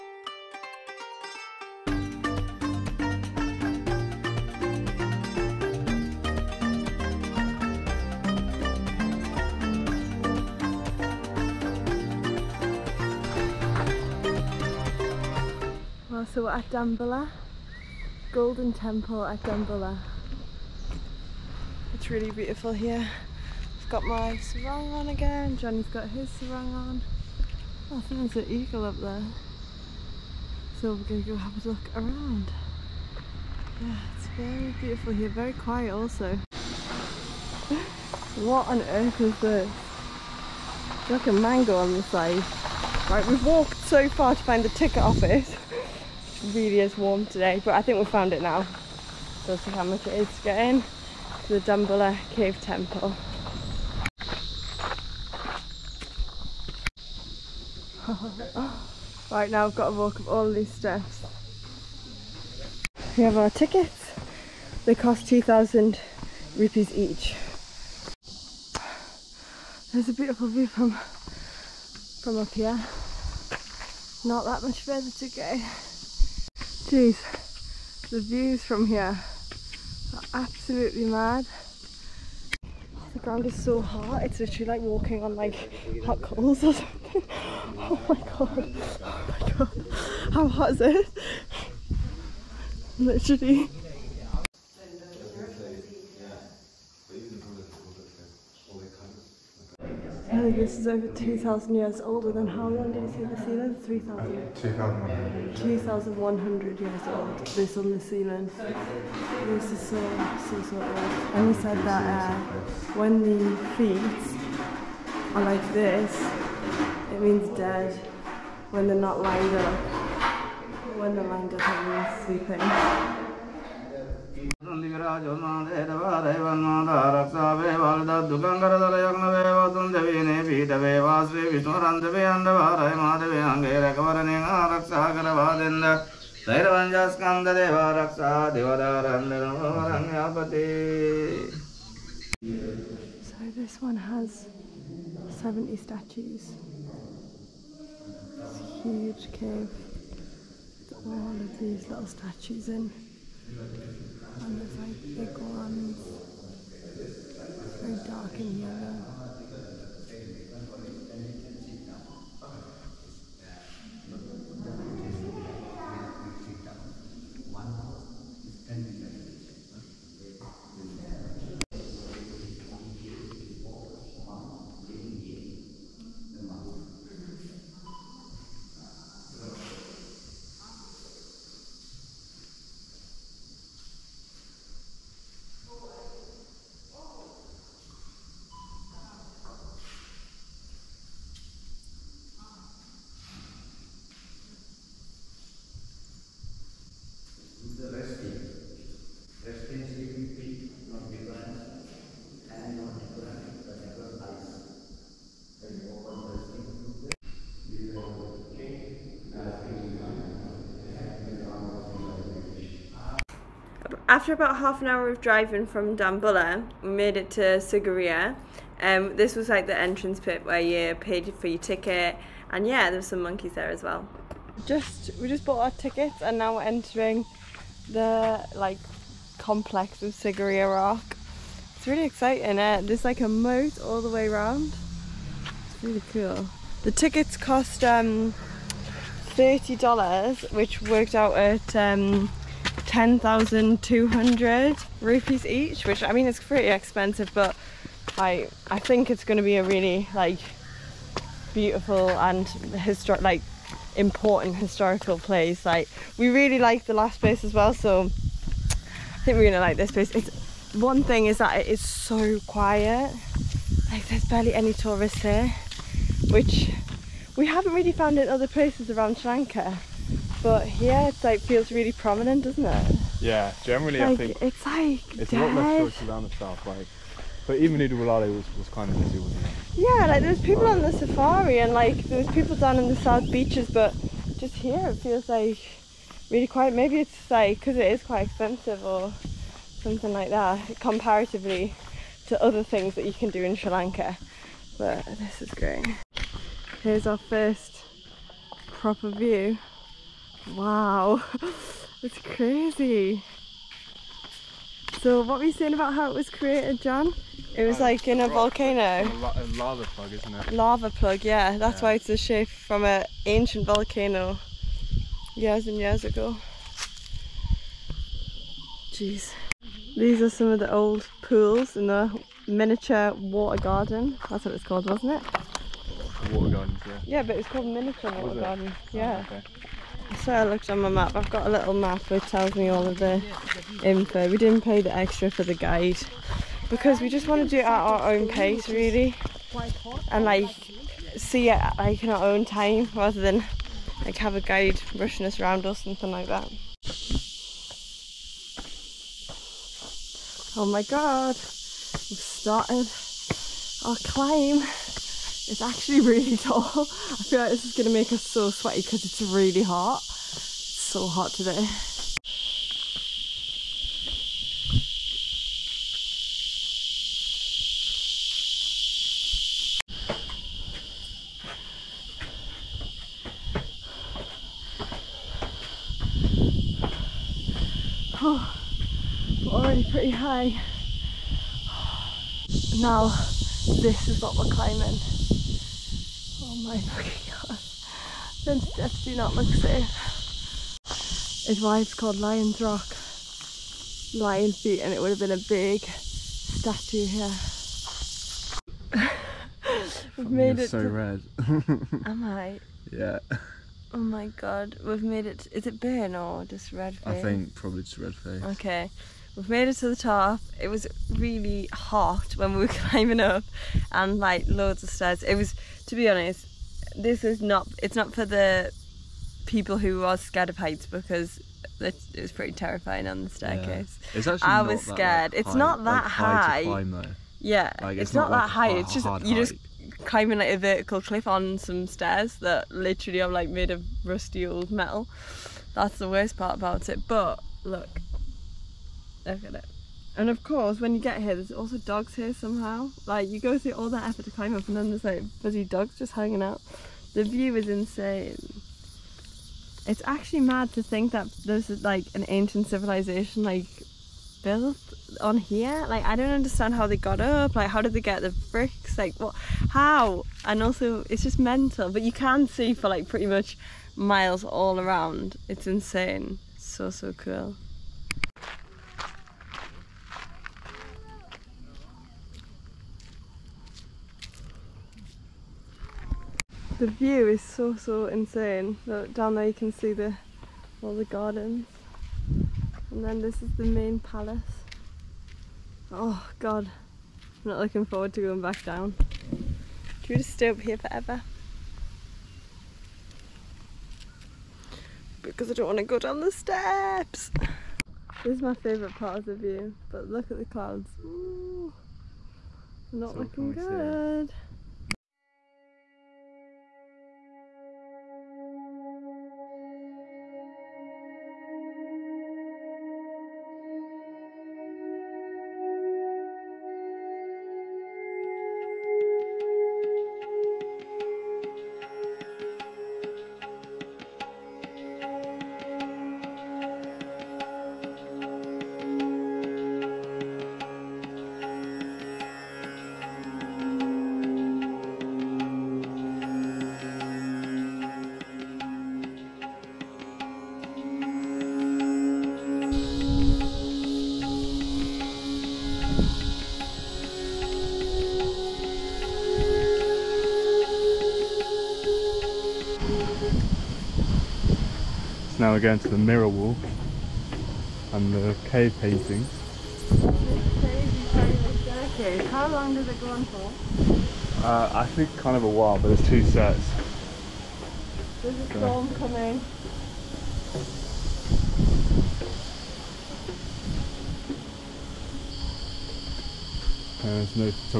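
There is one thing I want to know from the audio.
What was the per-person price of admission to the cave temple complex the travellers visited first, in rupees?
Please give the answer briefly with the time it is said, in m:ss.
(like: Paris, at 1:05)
2,000 rupees, at 1:05.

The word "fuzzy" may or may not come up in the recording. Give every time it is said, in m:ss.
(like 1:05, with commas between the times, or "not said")
7:25.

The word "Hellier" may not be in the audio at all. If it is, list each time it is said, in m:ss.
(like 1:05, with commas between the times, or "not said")
not said.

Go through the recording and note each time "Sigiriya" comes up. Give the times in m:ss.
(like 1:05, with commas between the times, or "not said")
3:37, 3:50.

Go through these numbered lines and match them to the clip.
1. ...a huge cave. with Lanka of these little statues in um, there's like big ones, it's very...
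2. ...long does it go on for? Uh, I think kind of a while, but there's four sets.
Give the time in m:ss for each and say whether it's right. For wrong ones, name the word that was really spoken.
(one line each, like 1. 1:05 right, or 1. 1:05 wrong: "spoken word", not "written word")
1. 2:28 wrong: "All", not "Lanka"
2. 9:22 wrong: "two", not "four".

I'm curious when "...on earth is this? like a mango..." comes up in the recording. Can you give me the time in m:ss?
0:38.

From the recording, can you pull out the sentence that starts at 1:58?
When they're not lined up, when they're lined up, it means sleeping.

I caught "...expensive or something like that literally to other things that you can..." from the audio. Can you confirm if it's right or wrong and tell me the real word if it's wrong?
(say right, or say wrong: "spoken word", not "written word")
wrong: "comparatively", not "literally".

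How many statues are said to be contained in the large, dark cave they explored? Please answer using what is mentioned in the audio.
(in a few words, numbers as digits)
70.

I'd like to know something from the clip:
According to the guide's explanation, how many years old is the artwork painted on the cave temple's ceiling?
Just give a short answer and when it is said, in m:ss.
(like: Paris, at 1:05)
2,100, at 1:45.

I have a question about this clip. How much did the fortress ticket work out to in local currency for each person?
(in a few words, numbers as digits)
10,200 rupees.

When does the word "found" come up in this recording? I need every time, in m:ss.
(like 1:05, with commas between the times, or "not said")
0:48, 4:27.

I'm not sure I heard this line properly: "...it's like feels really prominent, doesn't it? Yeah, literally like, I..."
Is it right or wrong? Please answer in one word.
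wrong.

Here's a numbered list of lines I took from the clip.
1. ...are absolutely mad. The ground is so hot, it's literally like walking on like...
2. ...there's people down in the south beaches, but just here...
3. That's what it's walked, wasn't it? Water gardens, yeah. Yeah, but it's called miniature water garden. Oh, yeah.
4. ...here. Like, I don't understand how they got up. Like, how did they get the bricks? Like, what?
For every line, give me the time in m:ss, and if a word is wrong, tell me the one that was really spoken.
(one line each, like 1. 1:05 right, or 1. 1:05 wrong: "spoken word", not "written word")
1. 1:20 right
2. 4:42 right
3. 5:24 wrong: "called", not "walked"
4. 7:35 right.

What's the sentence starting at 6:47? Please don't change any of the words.
I think probably just red face.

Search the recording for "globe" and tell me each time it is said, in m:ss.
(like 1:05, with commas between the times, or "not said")
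not said.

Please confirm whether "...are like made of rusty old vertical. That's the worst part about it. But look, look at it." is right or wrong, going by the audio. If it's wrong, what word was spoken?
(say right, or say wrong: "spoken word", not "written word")
wrong: "metal", not "vertical".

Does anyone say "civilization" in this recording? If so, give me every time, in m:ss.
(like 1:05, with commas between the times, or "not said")
7:32.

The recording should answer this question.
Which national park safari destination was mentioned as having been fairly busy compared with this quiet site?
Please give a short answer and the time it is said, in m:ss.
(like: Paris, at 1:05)
Udawalawe, at 4:37.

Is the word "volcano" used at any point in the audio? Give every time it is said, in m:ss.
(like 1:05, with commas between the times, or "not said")
5:08, 5:13.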